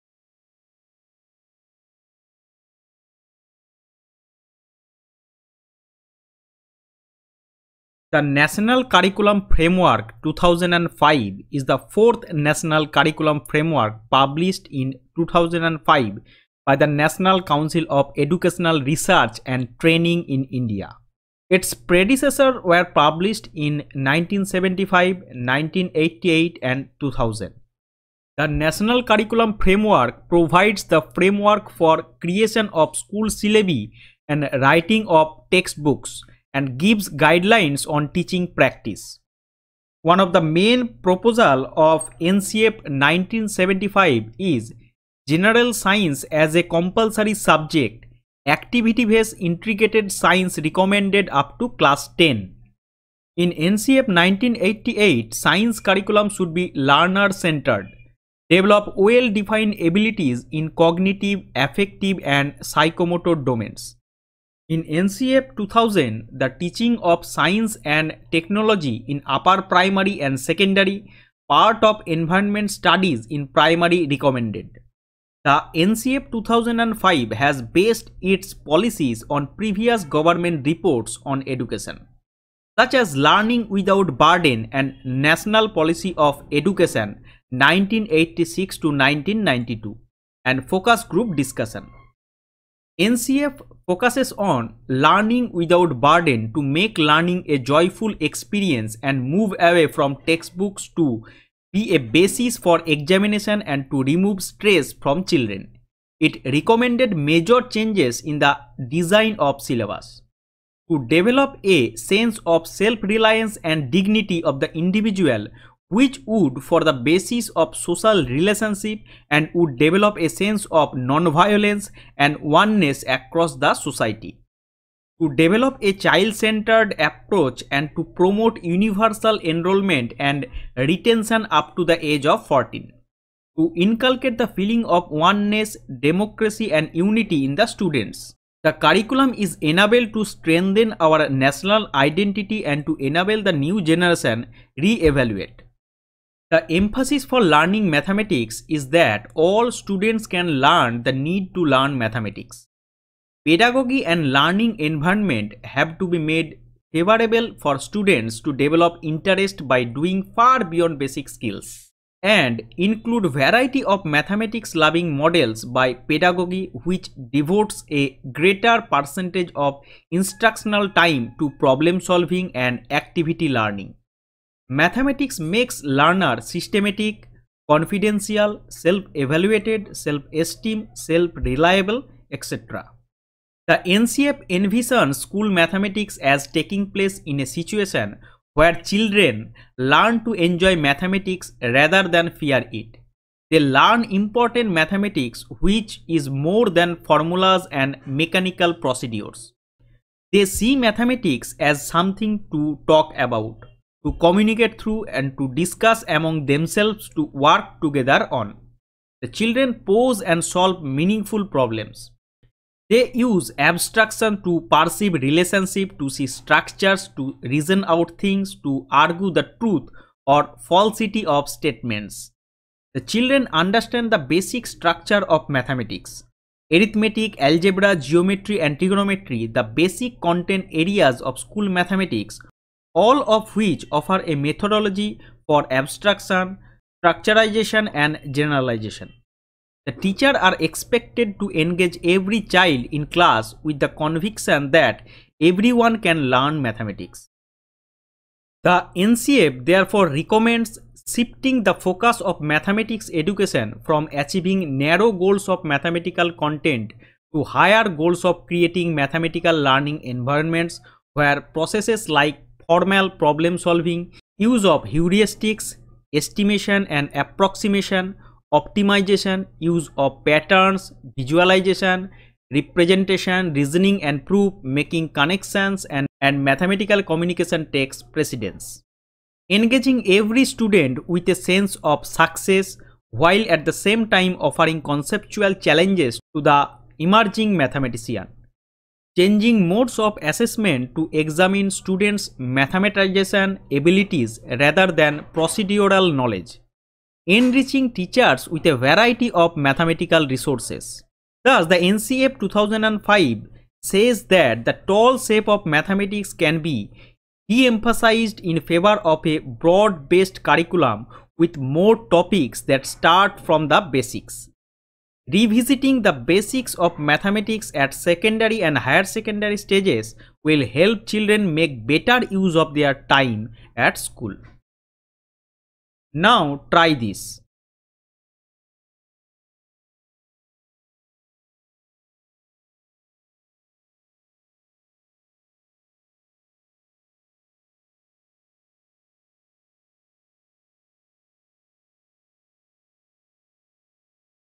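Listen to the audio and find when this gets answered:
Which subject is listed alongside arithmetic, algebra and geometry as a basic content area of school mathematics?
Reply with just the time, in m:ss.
3:48.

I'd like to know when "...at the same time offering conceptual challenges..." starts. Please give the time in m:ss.
4:43.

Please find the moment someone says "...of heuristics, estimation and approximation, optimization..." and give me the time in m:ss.
4:24.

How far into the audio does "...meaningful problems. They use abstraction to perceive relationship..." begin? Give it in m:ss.
3:30.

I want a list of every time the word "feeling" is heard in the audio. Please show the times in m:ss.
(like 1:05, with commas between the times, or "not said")
2:14.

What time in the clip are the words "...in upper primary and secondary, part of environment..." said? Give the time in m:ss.
1:09.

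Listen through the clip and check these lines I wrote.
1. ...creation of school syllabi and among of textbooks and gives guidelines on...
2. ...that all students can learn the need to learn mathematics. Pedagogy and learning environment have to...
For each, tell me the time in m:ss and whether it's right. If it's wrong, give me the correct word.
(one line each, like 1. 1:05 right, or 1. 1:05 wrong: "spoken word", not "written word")
1. 0:32 wrong: "writing", not "among"
2. 2:28 right.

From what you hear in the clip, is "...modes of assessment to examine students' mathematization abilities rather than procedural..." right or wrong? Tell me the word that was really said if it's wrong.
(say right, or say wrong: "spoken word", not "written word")
right.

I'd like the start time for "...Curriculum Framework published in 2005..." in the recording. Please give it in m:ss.
0:12.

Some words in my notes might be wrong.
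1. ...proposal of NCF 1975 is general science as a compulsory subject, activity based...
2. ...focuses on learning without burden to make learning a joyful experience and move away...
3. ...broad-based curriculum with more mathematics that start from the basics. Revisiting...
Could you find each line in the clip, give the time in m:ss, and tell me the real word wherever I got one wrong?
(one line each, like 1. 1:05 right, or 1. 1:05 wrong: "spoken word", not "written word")
1. 0:41 right
2. 1:33 right
3. 5:09 wrong: "topics", not "mathematics".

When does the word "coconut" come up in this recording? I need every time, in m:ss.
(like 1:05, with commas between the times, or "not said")
not said.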